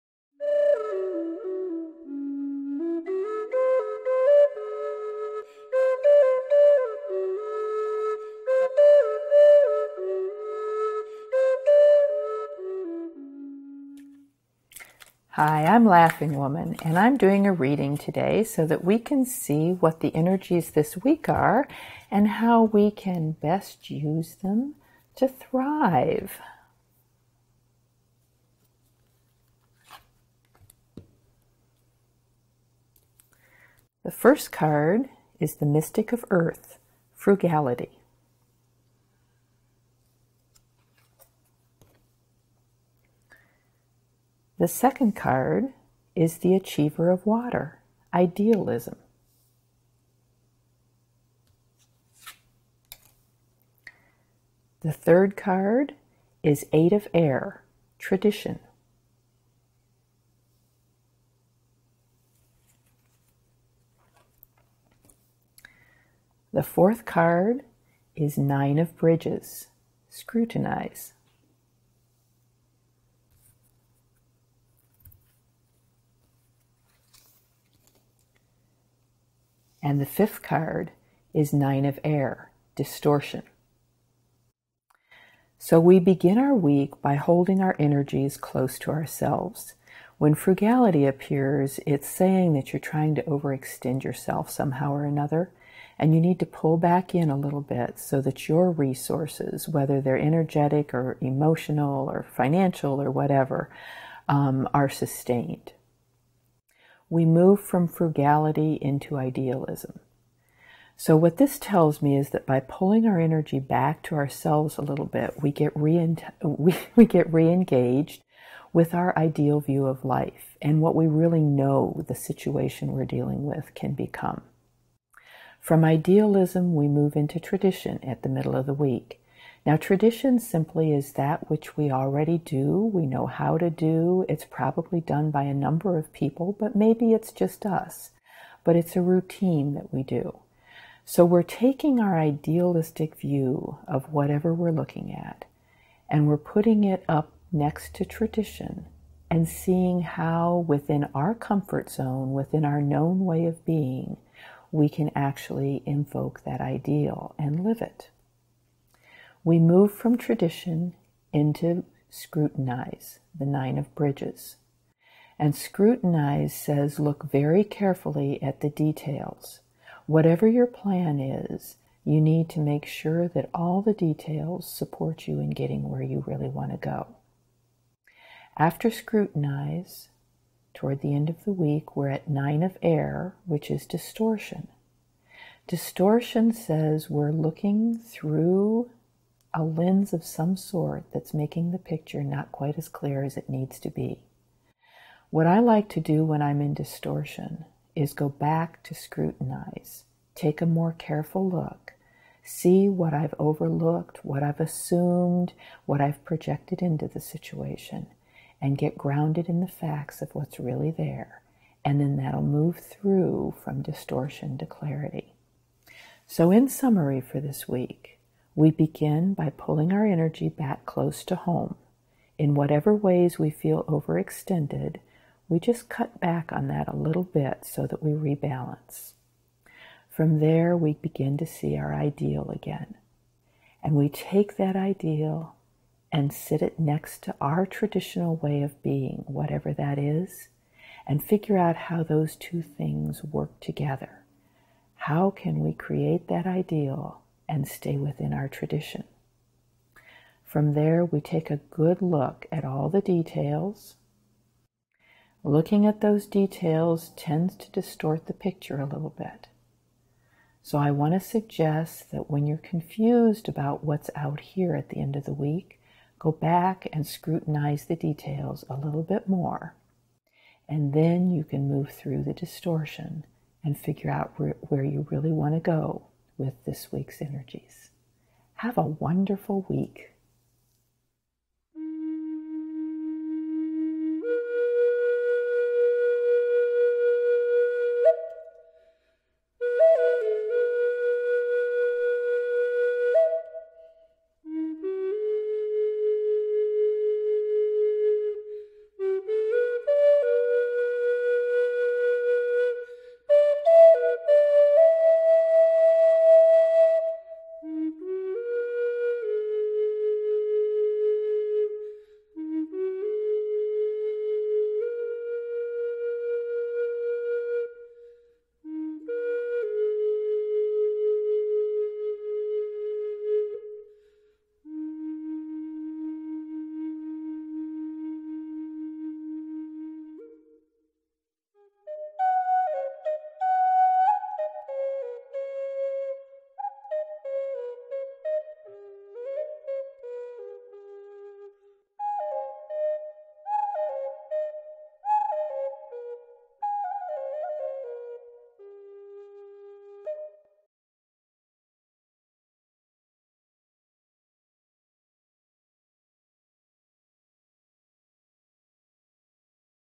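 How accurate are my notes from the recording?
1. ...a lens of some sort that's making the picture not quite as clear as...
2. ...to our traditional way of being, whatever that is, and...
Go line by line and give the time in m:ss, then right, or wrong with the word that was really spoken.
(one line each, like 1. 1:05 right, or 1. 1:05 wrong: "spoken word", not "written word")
1. 3:09 right
2. 3:57 right.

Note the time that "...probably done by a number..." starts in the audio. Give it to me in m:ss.
2:14.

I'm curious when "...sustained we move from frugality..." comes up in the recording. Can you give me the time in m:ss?
1:44.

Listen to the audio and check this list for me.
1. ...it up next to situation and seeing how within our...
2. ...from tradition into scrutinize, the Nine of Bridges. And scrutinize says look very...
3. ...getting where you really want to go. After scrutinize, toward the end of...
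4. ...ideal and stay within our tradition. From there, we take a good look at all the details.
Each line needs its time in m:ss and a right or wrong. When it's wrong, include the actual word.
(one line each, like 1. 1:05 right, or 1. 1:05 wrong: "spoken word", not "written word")
1. 2:26 wrong: "tradition", not "situation"
2. 2:39 right
3. 2:55 right
4. 4:06 right.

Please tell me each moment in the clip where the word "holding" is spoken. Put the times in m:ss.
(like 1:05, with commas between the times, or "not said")
1:27.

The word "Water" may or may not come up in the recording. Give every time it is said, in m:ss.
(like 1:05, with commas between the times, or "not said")
0:47.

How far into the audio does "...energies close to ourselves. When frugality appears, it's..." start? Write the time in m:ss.
1:27.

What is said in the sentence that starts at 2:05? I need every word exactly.
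From idealism, we move into tradition at the middle of the week.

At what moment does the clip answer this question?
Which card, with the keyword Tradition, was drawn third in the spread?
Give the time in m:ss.
0:56.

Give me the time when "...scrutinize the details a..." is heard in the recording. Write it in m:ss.
4:27.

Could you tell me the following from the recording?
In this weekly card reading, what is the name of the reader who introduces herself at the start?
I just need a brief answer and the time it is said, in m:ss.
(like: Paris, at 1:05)
Laughing Womyn, at 0:15.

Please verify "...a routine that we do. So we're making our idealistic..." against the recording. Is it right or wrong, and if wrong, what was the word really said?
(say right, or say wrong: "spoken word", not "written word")
wrong: "taking", not "making".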